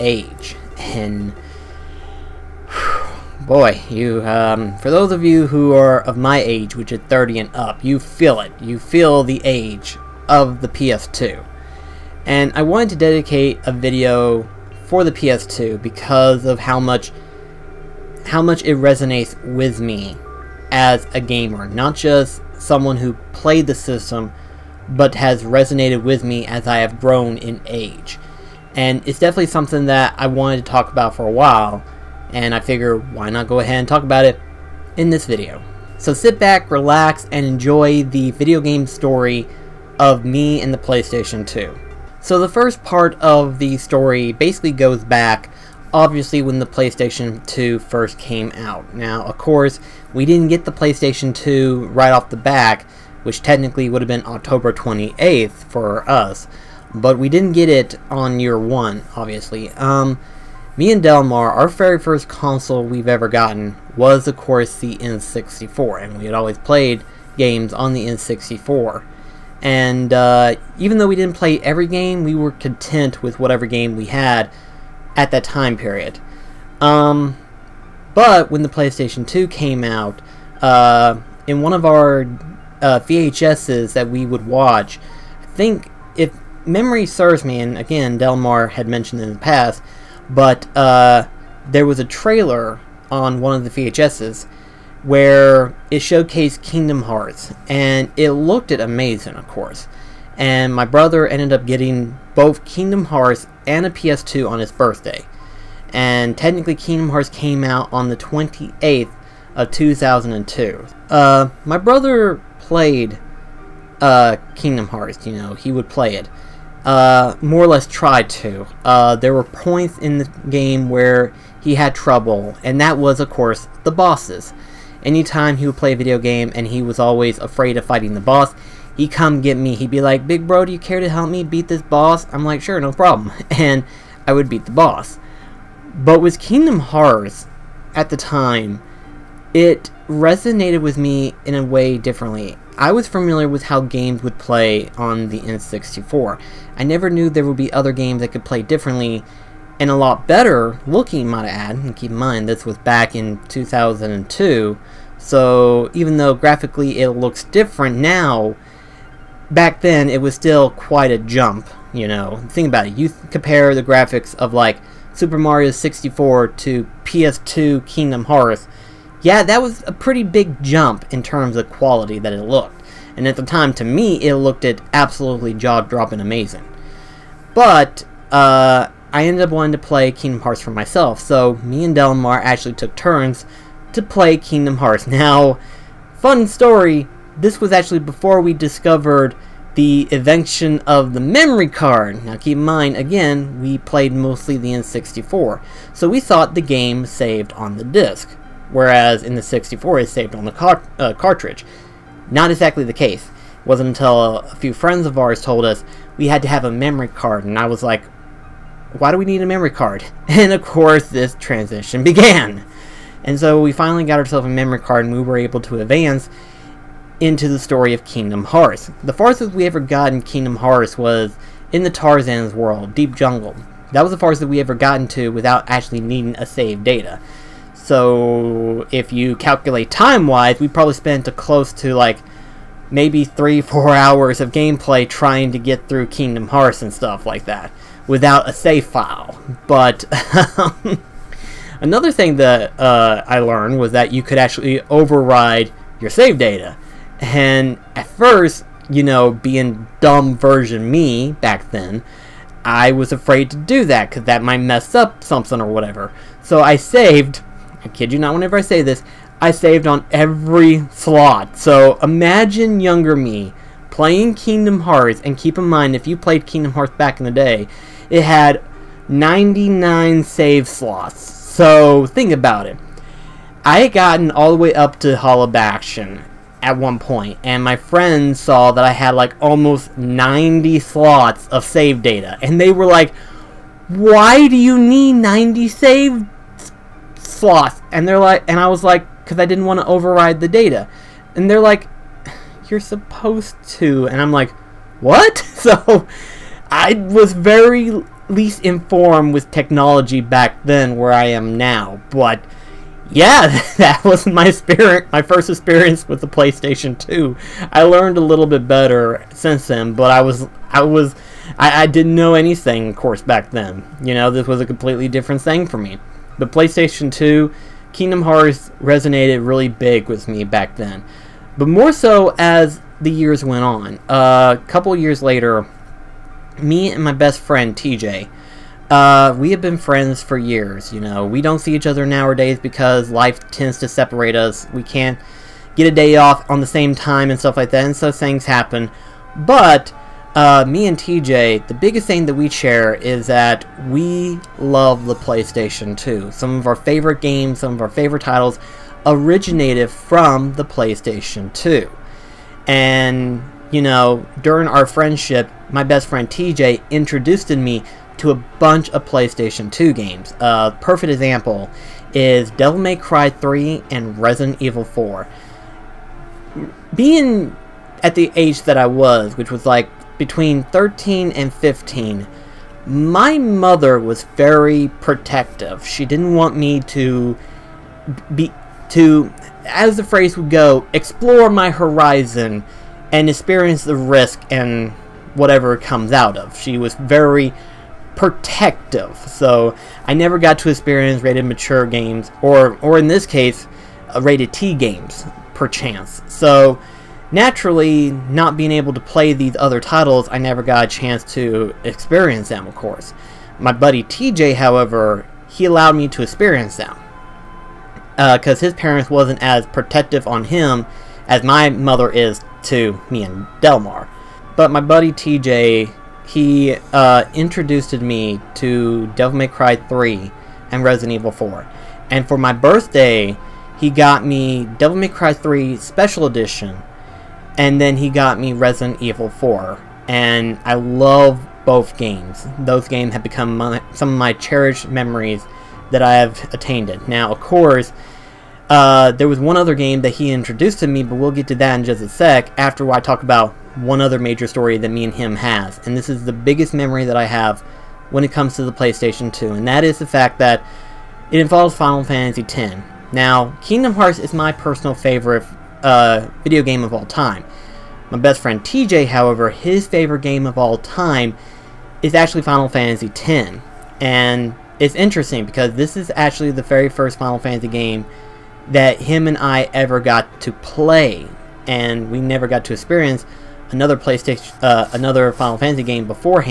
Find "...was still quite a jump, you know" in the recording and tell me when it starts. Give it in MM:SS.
02:40.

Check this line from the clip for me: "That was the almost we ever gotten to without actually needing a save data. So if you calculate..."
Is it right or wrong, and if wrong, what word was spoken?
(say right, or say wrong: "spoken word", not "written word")
wrong: "farthest", not "almost".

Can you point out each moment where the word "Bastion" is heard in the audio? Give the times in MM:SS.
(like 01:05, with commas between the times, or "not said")
04:35.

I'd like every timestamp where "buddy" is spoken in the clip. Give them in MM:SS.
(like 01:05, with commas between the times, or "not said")
06:43, 06:54.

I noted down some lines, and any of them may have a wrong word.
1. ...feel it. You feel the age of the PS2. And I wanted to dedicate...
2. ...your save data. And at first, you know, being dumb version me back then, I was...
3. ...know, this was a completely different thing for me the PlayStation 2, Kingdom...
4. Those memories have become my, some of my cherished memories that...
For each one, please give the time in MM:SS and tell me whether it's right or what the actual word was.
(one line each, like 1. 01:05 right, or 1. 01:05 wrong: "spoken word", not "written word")
1. 00:07 right
2. 04:06 right
3. 05:14 right
4. 07:12 wrong: "games", not "memories".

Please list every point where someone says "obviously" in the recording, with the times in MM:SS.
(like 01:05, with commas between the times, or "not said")
00:45, 00:59.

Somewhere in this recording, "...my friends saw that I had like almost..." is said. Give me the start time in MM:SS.
04:37.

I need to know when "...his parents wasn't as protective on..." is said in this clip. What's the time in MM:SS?
06:48.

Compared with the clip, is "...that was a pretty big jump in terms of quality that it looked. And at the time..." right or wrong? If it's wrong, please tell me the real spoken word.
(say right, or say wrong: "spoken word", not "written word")
right.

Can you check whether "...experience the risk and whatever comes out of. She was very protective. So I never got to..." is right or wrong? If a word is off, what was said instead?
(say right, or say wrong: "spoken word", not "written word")
right.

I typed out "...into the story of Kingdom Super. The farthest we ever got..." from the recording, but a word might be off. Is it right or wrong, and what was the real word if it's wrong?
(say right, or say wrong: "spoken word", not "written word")
wrong: "Hearts", not "Super".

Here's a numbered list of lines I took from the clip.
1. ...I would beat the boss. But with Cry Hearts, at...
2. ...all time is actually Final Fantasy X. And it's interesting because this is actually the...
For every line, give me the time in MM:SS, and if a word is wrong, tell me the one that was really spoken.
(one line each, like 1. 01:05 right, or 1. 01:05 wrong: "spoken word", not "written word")
1. 02:14 wrong: "Kingdom", not "Cry"
2. 07:40 right.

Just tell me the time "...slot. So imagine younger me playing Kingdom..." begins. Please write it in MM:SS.
04:20.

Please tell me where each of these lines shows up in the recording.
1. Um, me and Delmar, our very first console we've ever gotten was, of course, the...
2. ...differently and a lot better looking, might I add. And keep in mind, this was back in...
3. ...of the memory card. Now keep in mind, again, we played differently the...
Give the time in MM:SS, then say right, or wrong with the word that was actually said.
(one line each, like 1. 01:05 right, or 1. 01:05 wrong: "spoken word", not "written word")
1. 00:59 right
2. 02:28 right
3. 03:10 wrong: "mostly", not "differently".